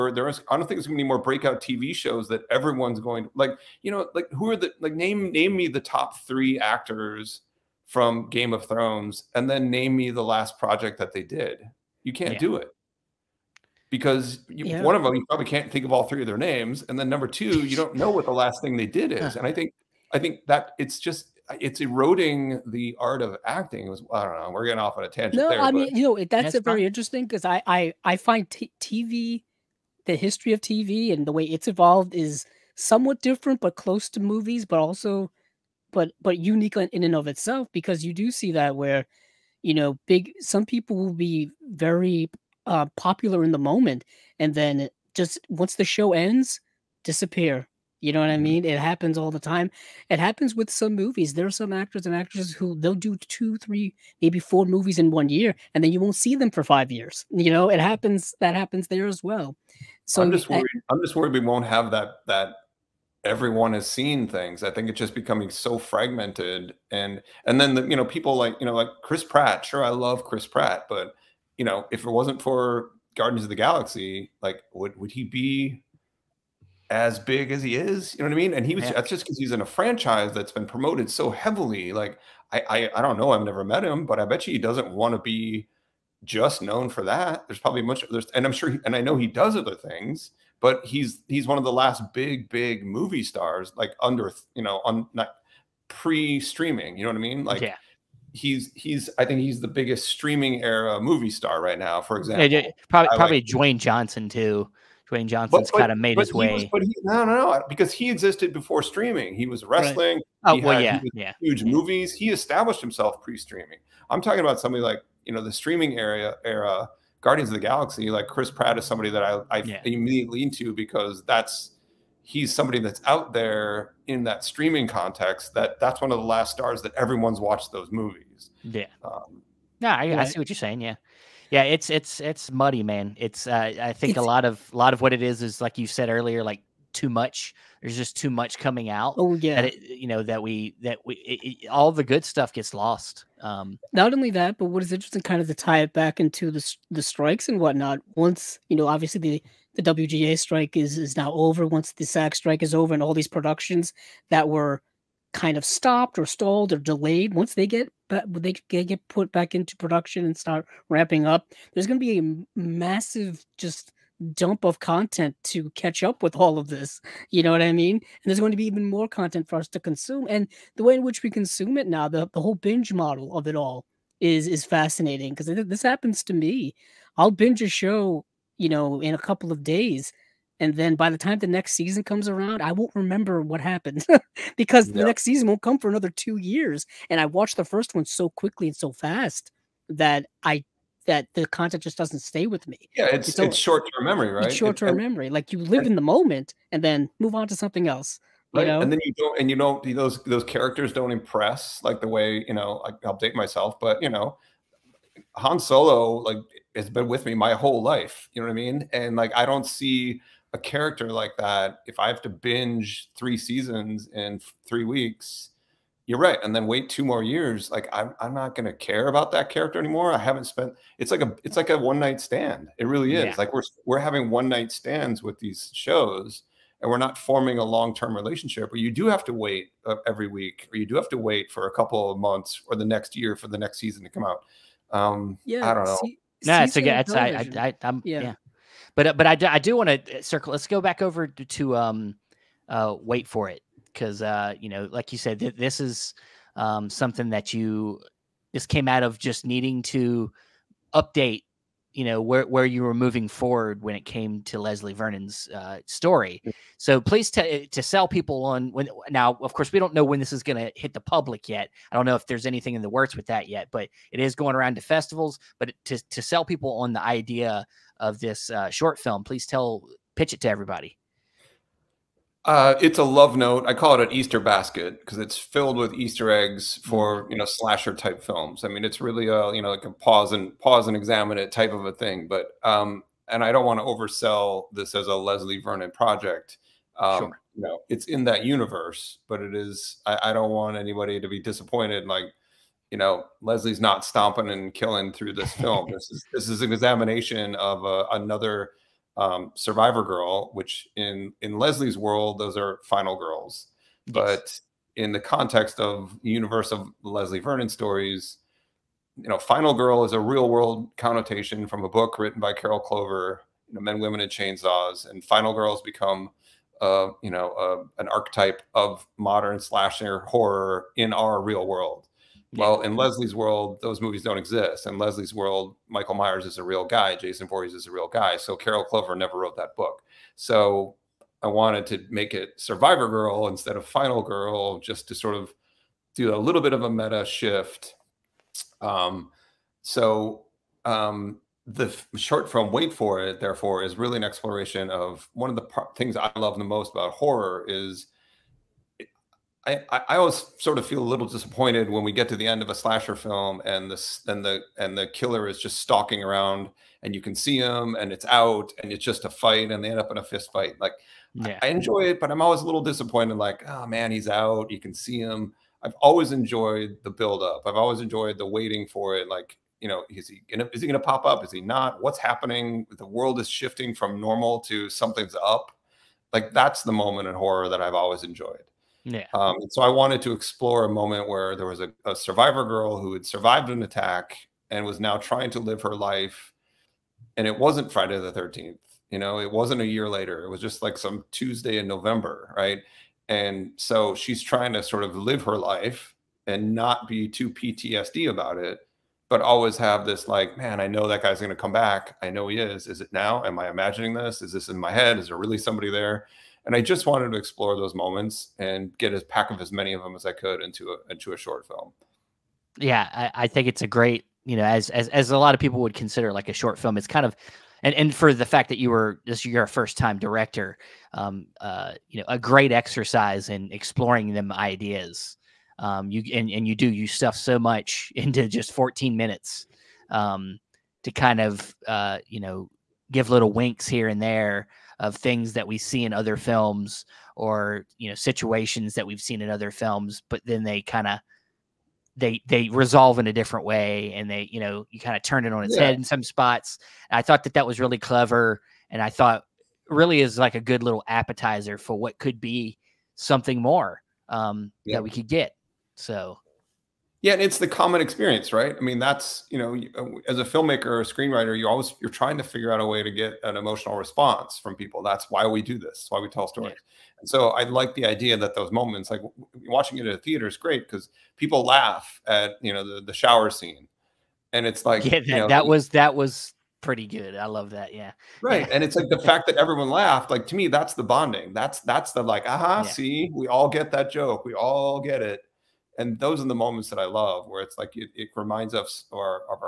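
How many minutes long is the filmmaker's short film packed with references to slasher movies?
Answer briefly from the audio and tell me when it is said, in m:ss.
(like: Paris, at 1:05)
14, at 7:08.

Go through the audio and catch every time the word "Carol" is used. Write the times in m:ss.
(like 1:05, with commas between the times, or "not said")
5:12, 5:28.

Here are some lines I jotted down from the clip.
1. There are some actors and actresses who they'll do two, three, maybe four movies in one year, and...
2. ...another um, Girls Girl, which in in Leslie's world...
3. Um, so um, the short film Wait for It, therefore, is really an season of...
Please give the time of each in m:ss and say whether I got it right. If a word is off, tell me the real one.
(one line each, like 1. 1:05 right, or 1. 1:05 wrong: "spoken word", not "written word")
1. 0:51 right
2. 4:58 wrong: "Survivor", not "Girls"
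3. 5:38 wrong: "exploration", not "season".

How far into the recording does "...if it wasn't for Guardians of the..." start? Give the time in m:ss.
1:11.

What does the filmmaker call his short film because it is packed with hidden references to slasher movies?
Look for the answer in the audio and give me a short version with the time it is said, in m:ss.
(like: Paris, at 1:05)
An Easter basket, at 4:34.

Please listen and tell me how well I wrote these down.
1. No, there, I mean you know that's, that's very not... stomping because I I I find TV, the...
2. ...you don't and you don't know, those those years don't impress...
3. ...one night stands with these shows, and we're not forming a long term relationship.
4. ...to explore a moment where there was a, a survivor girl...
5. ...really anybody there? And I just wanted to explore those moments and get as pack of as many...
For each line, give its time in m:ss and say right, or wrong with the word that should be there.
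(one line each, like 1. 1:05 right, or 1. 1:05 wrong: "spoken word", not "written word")
1. 0:25 wrong: "interesting", not "stomping"
2. 3:19 wrong: "characters", not "years"
3. 3:44 right
4. 6:20 right
5. 6:45 wrong: "somebody", not "anybody".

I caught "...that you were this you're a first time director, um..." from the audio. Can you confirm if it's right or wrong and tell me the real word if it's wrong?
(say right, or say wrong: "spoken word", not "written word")
right.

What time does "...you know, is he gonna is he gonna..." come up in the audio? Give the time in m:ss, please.
6:09.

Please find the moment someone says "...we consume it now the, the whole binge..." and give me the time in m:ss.
2:51.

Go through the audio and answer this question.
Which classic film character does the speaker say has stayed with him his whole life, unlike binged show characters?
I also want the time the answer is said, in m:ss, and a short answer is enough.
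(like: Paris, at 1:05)
Han Solo, at 3:25.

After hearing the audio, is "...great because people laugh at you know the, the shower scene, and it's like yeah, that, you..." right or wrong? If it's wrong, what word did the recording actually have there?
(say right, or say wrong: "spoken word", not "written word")
right.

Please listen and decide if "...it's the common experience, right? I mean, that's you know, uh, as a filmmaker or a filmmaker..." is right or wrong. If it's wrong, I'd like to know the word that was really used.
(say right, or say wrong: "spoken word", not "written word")
wrong: "screenwriter", not "filmmaker".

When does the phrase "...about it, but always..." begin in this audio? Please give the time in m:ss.
6:38.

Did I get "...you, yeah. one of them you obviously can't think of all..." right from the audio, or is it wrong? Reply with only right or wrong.
wrong.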